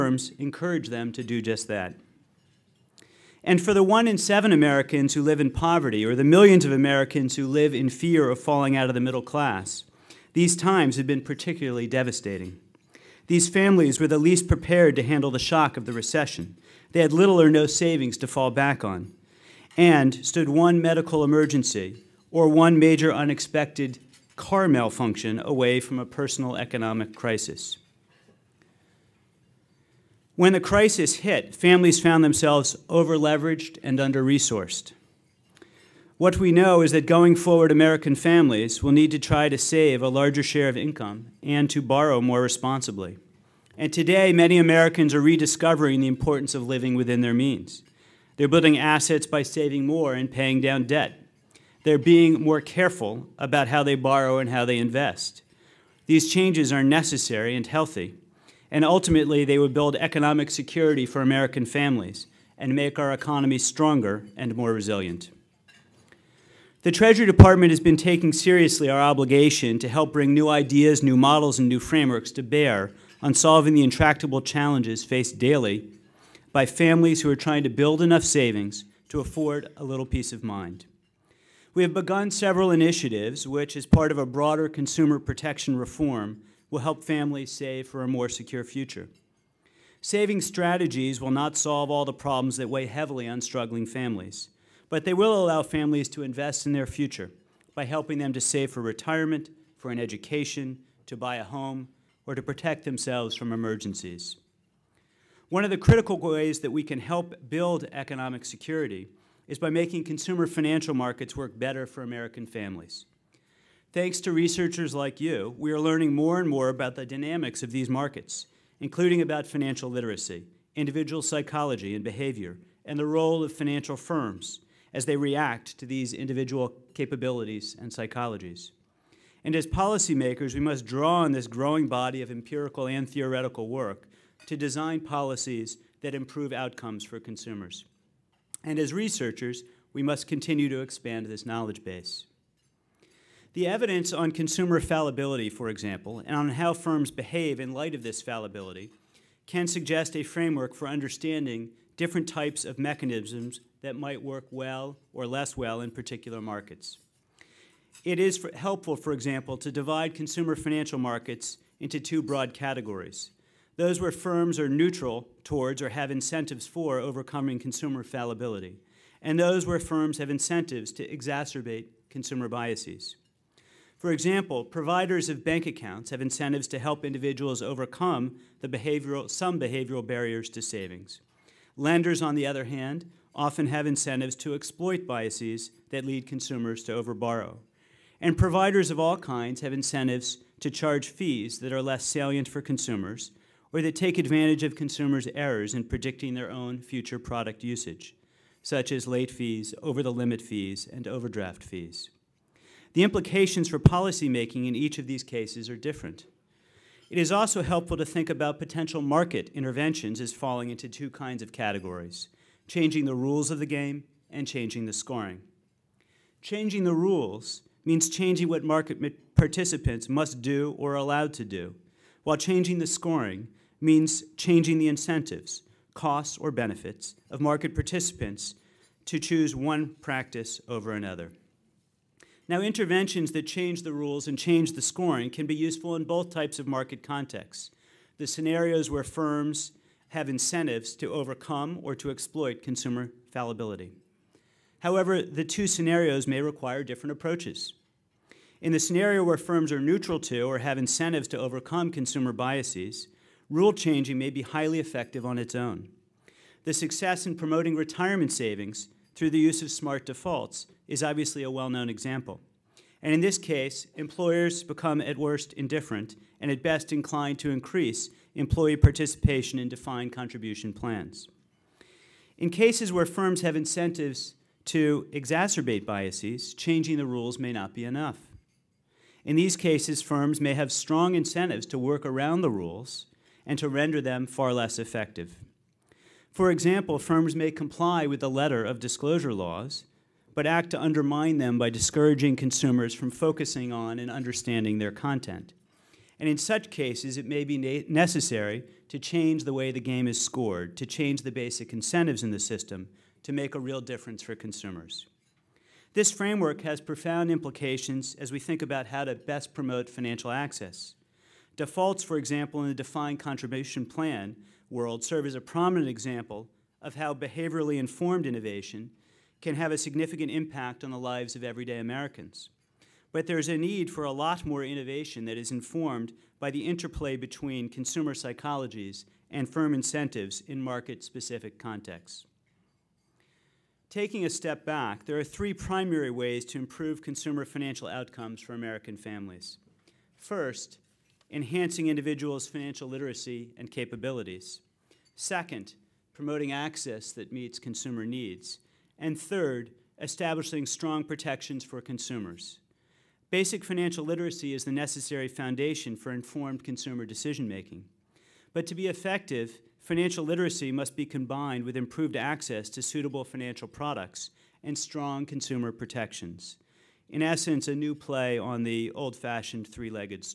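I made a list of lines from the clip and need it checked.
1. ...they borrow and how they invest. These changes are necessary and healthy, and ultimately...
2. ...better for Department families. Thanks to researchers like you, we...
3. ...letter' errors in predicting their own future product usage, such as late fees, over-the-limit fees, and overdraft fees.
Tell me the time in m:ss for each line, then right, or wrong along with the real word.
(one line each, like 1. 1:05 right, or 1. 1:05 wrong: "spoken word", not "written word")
1. 0:53 right
2. 1:51 wrong: "American", not "Department"
3. 3:14 wrong: "consumers", not "letter".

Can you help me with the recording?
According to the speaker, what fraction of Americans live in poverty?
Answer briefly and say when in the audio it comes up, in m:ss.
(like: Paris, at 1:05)
1 in 7, at 0:03.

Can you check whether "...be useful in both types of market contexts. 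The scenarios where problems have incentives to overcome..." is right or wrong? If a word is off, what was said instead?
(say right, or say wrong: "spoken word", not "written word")
wrong: "firms", not "problems".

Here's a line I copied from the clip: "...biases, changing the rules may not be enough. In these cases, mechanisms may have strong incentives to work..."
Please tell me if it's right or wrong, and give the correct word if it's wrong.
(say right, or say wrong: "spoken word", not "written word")
wrong: "firms", not "mechanisms".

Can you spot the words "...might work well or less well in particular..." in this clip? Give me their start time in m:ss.
2:33.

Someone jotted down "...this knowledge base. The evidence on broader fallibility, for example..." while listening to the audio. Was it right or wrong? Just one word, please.
wrong.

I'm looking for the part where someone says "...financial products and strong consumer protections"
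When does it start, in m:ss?
6:03.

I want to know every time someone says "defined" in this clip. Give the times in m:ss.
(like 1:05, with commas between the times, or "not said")
4:29, 5:12.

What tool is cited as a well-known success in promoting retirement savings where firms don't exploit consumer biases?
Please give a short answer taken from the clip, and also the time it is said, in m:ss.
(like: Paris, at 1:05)
smart defaults, at 4:19.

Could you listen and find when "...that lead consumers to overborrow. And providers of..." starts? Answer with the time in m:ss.
3:05.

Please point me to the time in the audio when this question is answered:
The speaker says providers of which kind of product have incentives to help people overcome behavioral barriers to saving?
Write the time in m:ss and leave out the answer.
2:55.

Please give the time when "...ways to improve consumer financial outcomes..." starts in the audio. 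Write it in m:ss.
5:36.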